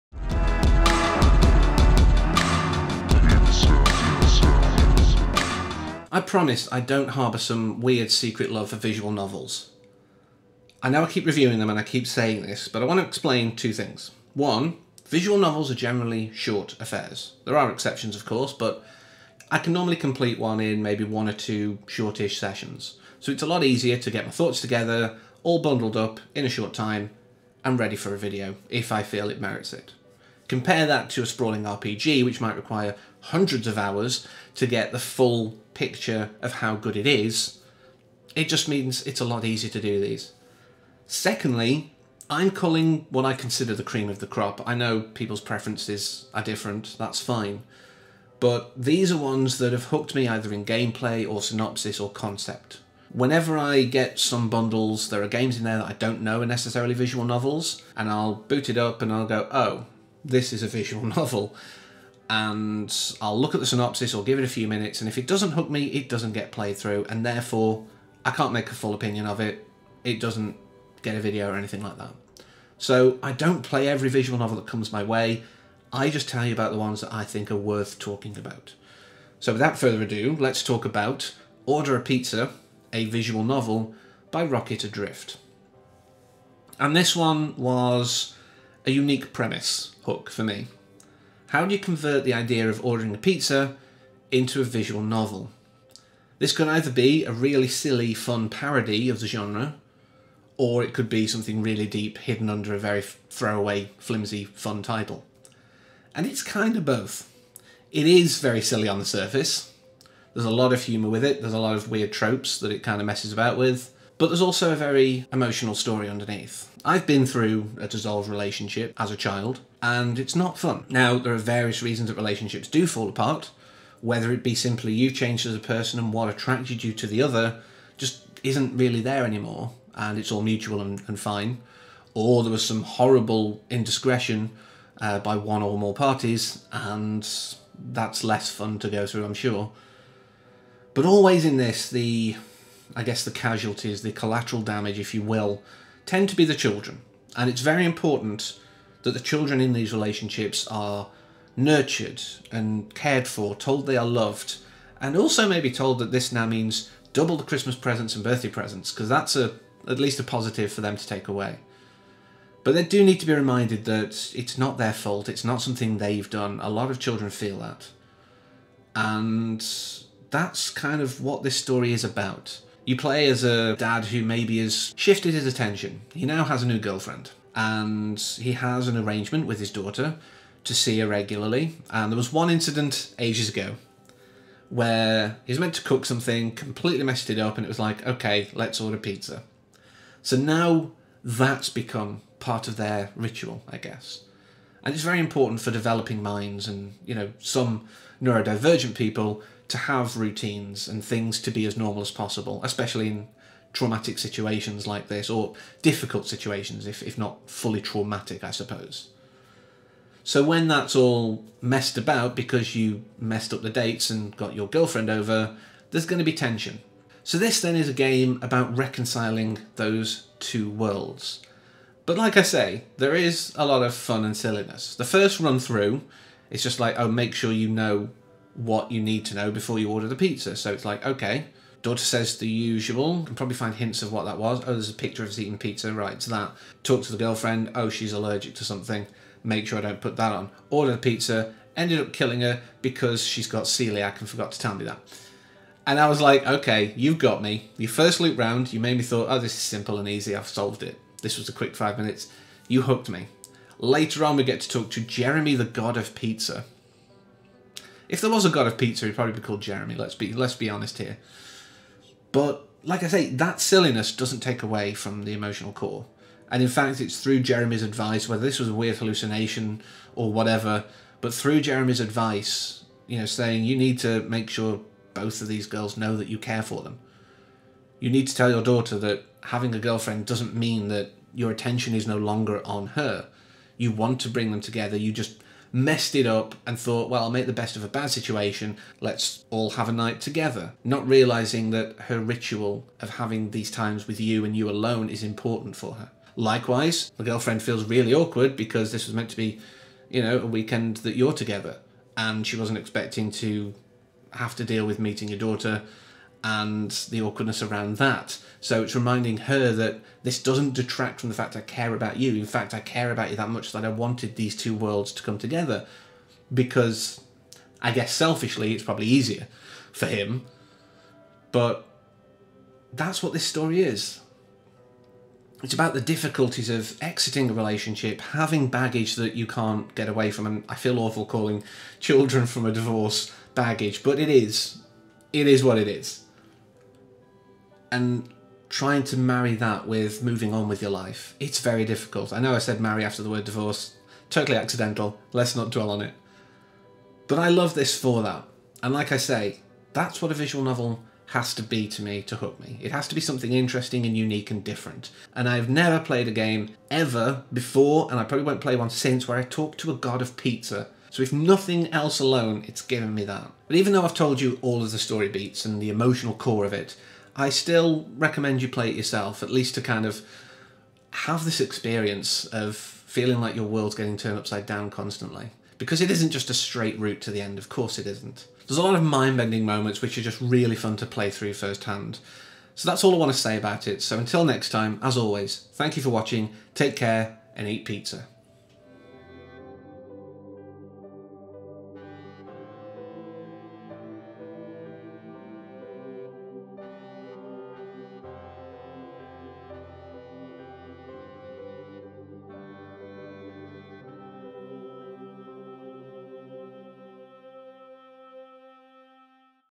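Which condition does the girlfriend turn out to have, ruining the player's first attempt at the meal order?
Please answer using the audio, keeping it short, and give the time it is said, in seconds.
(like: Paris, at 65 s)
celiac, at 243 s.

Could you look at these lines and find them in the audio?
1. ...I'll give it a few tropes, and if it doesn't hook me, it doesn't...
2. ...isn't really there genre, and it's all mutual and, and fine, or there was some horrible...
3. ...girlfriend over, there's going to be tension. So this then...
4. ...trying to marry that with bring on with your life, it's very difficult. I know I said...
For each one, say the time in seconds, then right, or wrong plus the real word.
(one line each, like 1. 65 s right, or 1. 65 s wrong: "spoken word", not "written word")
1. 64 s wrong: "minutes", not "tropes"
2. 128 s wrong: "anymore", not "genre"
3. 214 s right
4. 338 s wrong: "moving", not "bring".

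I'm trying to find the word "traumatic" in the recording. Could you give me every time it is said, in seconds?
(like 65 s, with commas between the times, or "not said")
203 s, 207 s.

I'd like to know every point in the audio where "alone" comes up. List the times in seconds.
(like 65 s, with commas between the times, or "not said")
294 s, 362 s.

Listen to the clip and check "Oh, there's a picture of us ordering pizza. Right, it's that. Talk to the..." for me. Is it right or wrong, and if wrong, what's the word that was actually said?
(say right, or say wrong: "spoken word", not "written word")
wrong: "eating", not "ordering".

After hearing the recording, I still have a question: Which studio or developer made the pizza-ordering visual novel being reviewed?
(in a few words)
Rocket Adrift.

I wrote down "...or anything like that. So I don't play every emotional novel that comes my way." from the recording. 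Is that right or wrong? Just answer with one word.
wrong.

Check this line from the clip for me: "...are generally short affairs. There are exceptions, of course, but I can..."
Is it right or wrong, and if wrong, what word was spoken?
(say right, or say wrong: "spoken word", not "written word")
right.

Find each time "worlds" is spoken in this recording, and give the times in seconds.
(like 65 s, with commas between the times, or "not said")
220 s, 314 s, 373 s.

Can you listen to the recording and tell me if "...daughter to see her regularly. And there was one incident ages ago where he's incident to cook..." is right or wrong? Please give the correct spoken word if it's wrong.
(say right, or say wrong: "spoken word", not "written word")
wrong: "meant", not "incident".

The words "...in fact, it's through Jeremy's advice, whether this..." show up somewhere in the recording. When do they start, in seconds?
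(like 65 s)
266 s.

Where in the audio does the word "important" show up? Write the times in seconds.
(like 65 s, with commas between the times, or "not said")
147 s, 195 s, 295 s.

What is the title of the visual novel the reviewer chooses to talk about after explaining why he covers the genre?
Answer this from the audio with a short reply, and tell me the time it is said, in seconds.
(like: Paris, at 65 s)
Order a Pizza, at 81 s.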